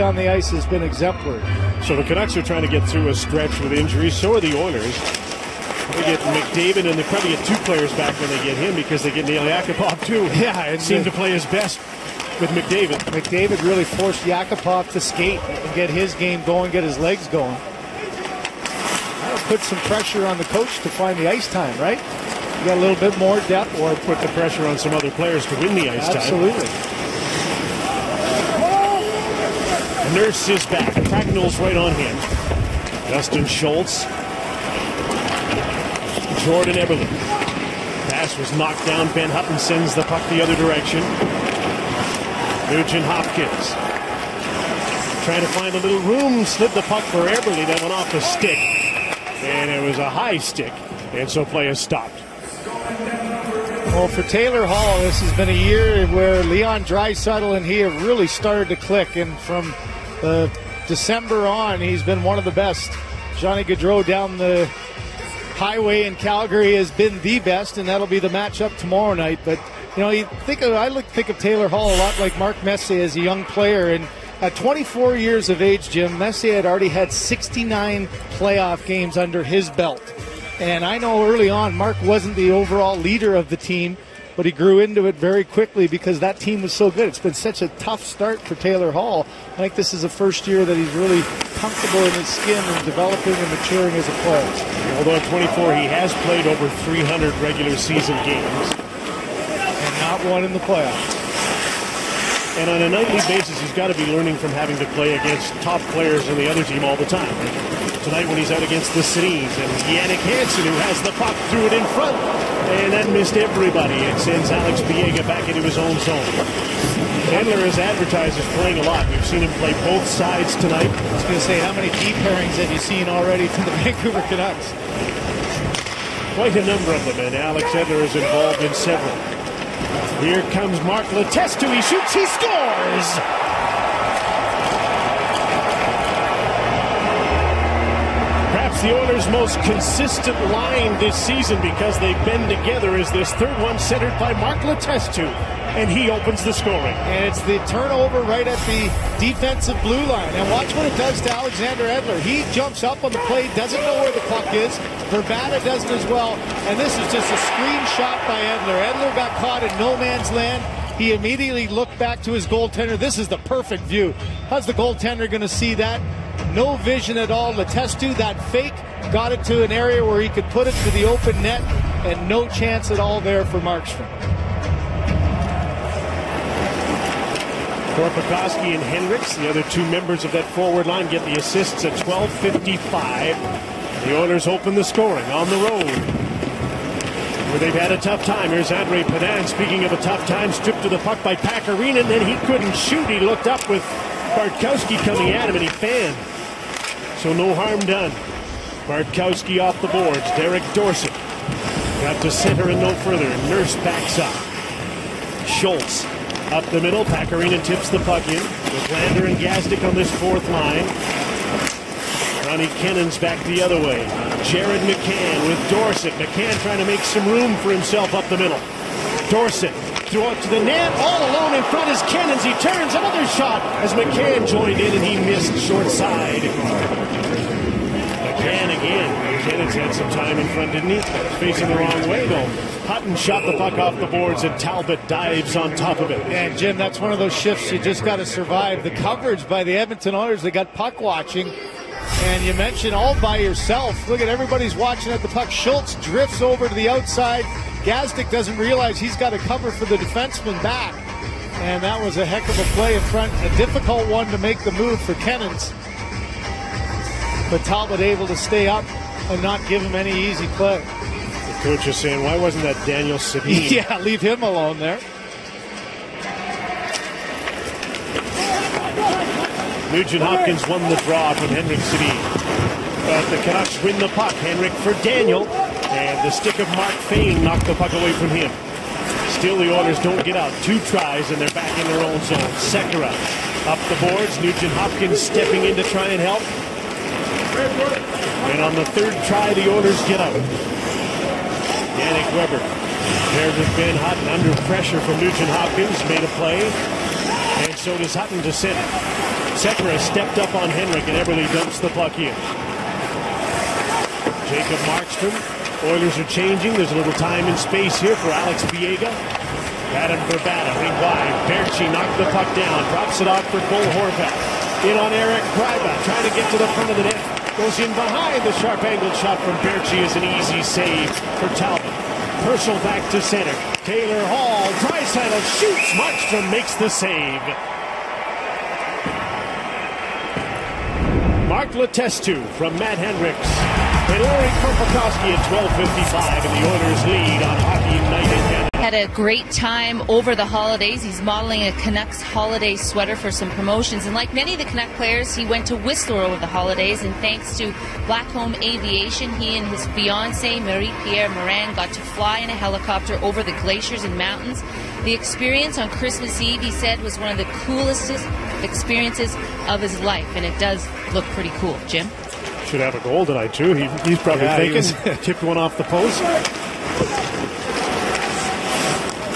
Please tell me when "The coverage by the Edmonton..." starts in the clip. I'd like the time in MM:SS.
03:58.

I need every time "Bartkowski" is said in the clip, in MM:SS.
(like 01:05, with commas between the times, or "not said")
03:14, 03:18.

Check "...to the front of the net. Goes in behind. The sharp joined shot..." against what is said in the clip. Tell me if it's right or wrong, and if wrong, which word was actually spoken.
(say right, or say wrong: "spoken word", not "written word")
wrong: "angled", not "joined".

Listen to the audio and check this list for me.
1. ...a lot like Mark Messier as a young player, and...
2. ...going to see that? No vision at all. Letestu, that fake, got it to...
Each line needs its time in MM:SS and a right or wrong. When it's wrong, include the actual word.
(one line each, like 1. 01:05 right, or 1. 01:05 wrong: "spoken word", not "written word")
1. 01:11 right
2. 02:45 right.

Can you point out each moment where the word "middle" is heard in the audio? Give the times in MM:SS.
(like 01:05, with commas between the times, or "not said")
03:26, 03:38.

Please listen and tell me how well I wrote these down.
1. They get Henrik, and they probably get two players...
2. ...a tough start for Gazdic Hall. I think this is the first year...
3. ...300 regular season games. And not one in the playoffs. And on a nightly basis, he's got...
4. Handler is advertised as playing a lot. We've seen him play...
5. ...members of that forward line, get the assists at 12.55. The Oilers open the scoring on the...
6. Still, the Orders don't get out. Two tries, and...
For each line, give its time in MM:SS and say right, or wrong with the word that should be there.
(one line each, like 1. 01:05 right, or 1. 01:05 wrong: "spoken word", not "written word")
1. 00:05 wrong: "McDavid", not "Henrik"
2. 01:27 wrong: "Taylor", not "Gazdic"
3. 01:36 right
4. 01:57 right
5. 02:59 right
6. 04:39 right.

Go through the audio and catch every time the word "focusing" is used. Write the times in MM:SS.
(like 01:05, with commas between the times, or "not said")
not said.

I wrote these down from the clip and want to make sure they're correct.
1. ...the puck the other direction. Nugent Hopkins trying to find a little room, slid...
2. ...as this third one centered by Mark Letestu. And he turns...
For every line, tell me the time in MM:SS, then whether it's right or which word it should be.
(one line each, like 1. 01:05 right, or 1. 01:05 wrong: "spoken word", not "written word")
1. 00:39 right
2. 02:22 wrong: "opens", not "turns".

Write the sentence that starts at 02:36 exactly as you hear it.
And this is just a screenshot by Edler.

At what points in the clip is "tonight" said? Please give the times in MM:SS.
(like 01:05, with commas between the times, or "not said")
01:48, 02:00, 06:03.